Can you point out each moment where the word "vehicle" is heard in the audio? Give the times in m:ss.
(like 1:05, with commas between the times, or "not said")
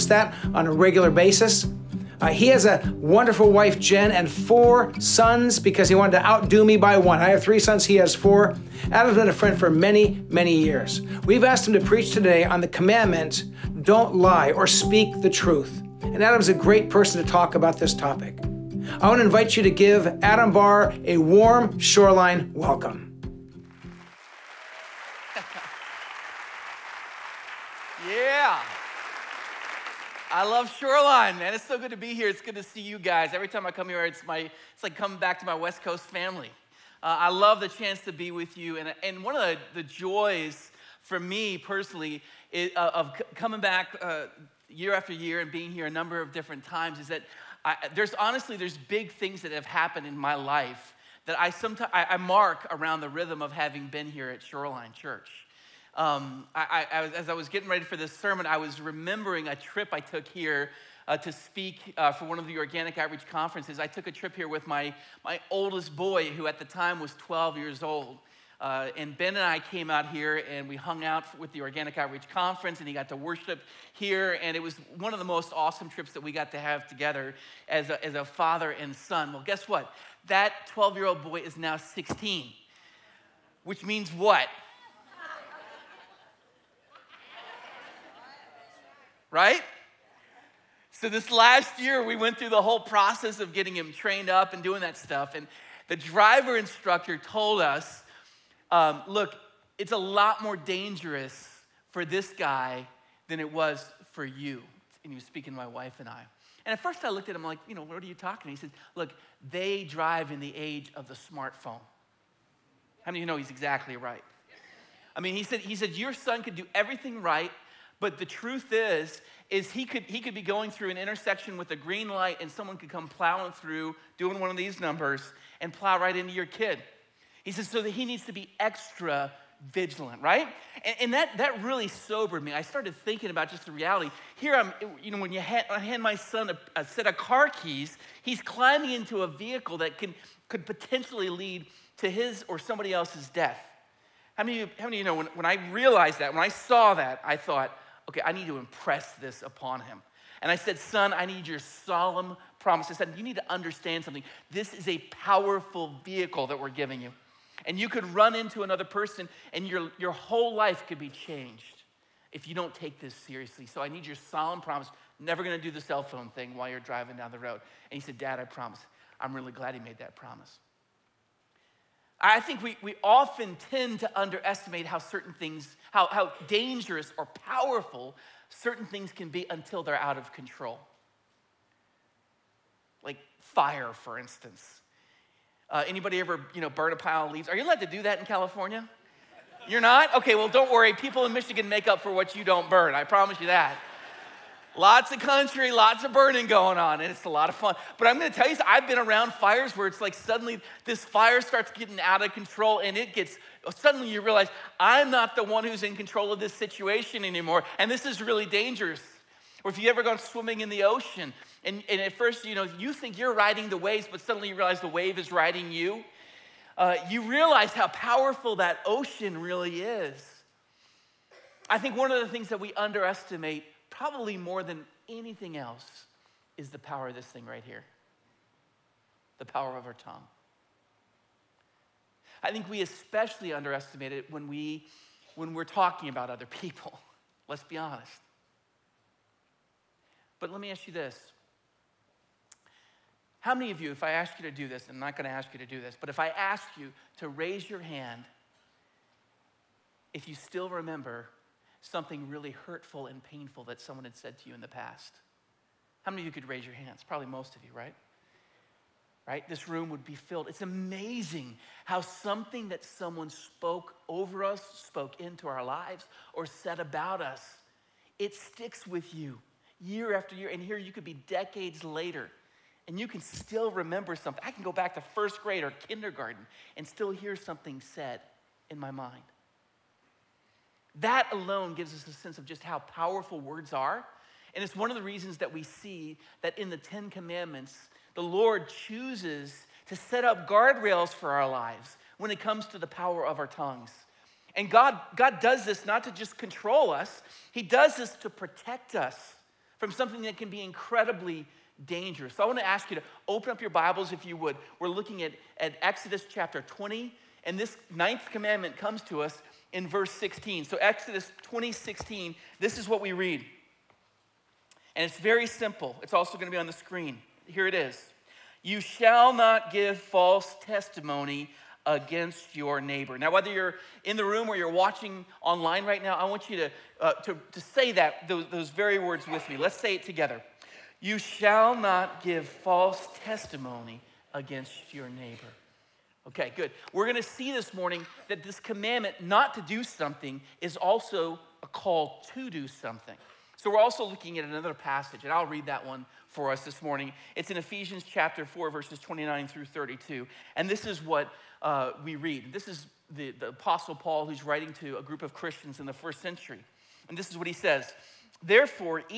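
2:19, 2:36.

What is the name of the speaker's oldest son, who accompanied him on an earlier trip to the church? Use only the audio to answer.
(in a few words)
Ben.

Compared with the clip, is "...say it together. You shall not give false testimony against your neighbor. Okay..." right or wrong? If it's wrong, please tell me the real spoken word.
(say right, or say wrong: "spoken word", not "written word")
right.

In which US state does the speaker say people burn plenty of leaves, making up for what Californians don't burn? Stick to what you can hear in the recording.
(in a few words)
Michigan.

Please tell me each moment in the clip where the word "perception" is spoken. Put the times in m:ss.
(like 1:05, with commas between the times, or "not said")
not said.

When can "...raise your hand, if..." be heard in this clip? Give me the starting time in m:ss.
4:07.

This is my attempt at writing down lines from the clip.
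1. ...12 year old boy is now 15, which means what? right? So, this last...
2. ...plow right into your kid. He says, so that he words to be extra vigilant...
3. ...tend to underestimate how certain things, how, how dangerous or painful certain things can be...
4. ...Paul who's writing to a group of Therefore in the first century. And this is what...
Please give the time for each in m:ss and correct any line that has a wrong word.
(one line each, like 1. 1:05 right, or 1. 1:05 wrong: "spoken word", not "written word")
1. 1:20 wrong: "16", not "15"
2. 2:05 wrong: "needs", not "words"
3. 2:53 wrong: "powerful", not "painful"
4. 5:53 wrong: "Christians", not "Therefore".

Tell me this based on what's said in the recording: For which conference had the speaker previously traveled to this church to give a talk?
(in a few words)
Organic Outreach Conference.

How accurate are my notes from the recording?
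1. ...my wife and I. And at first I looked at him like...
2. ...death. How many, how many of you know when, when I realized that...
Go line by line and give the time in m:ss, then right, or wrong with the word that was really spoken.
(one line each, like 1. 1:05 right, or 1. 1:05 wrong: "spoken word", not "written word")
1. 1:45 right
2. 2:23 right.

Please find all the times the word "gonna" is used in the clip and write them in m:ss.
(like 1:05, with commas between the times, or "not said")
2:45, 3:18.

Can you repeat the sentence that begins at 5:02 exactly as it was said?
So I want to ask you to open up your Bibles if you would.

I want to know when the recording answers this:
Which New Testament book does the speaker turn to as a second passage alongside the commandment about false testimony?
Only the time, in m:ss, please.
5:47.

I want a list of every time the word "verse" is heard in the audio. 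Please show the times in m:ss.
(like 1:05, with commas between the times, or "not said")
5:09, 5:48.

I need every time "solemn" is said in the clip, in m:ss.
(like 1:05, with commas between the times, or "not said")
2:31, 2:44.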